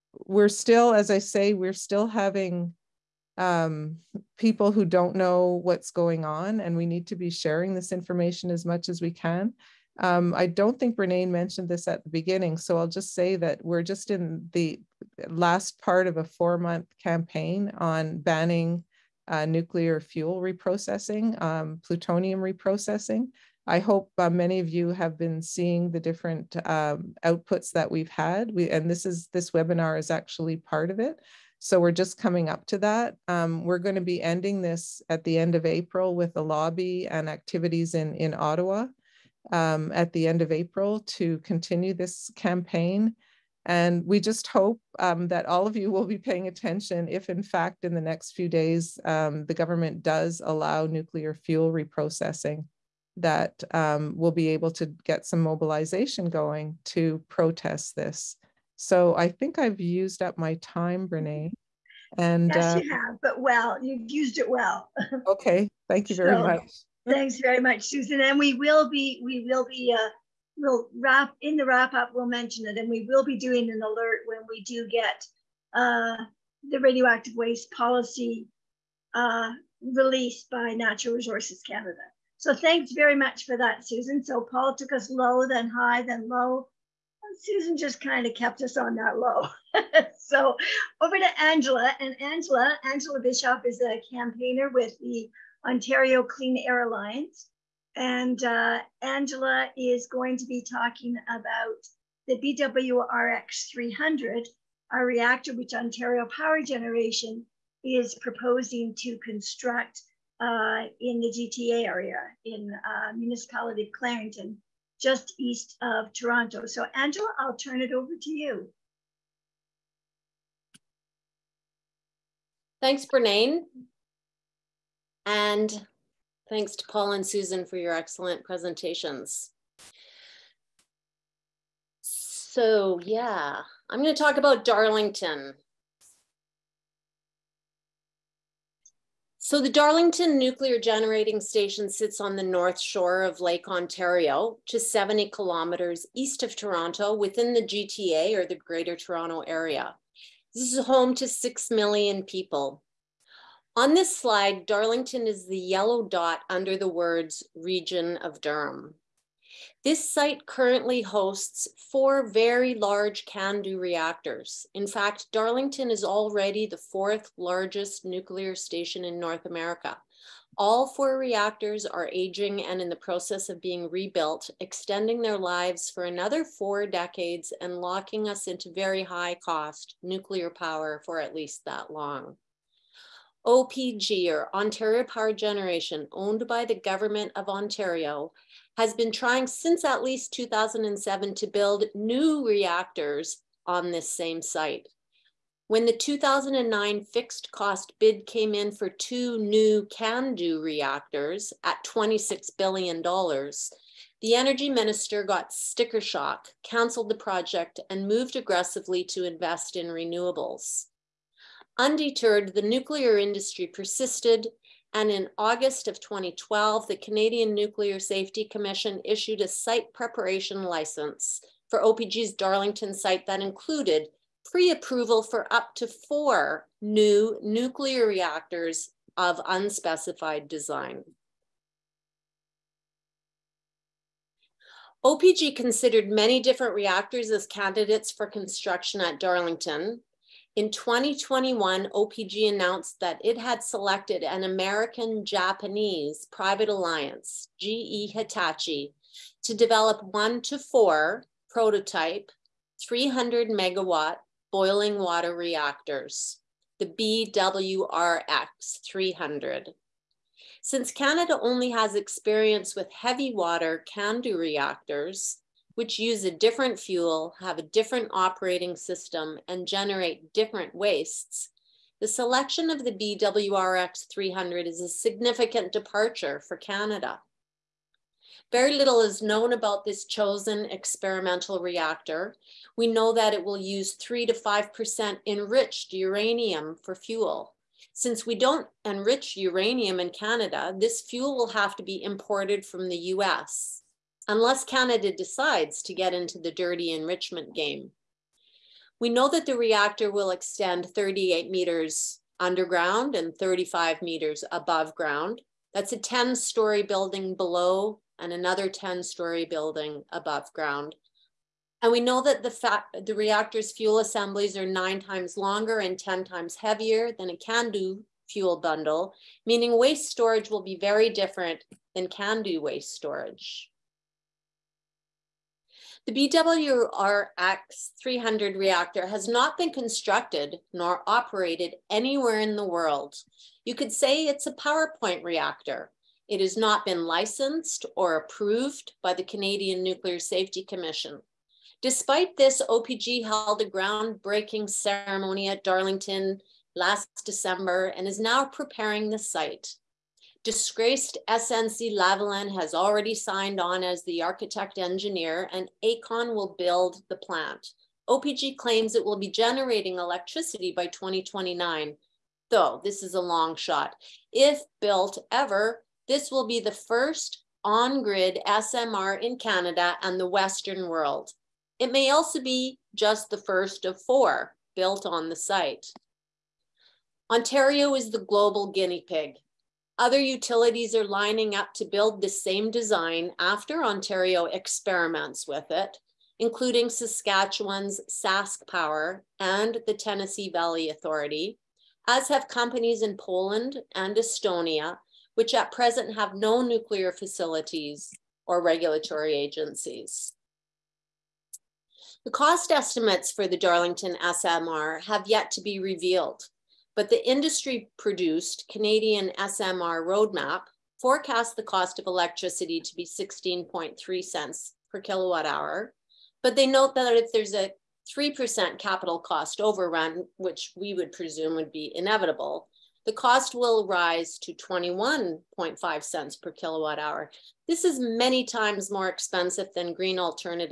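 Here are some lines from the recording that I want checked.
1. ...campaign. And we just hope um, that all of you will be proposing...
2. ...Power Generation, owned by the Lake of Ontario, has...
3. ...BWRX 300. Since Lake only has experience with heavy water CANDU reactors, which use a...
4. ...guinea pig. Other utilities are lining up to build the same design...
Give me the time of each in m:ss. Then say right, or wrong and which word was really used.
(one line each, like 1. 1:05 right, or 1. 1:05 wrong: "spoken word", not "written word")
1. 0:42 wrong: "paying", not "proposing"
2. 3:05 wrong: "Government", not "Lake"
3. 4:16 wrong: "Canada", not "Lake"
4. 6:18 right.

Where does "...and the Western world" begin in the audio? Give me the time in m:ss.
6:10.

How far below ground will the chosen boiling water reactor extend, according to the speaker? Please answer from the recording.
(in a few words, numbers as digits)
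38 meters.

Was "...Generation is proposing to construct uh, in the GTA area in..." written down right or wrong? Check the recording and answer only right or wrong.
right.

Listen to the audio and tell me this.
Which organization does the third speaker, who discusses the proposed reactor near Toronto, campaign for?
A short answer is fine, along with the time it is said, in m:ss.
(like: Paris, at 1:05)
Ontario Clean Air Alliance, at 1:35.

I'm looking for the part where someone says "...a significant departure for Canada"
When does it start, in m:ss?
4:34.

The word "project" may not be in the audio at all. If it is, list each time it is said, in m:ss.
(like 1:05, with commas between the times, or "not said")
3:27.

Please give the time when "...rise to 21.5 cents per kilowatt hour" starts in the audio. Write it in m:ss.
7:03.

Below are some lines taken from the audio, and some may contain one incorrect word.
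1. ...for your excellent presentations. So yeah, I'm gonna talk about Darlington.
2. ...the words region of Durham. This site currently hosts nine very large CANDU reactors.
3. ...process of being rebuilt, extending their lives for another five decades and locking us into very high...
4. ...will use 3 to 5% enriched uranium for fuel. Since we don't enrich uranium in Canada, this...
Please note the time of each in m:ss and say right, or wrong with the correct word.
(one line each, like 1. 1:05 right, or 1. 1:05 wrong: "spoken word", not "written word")
1. 2:07 right
2. 2:36 wrong: "four", not "nine"
3. 2:52 wrong: "four", not "five"
4. 4:43 right.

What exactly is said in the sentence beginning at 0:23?
I hope uh, many of you have been seeing the different um, outputs that we've had.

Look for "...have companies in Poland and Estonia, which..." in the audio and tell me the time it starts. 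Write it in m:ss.
6:32.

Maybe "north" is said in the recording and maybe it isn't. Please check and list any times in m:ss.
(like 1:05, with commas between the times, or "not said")
2:22, 2:49.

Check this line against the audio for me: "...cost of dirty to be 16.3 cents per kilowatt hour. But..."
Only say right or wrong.
wrong.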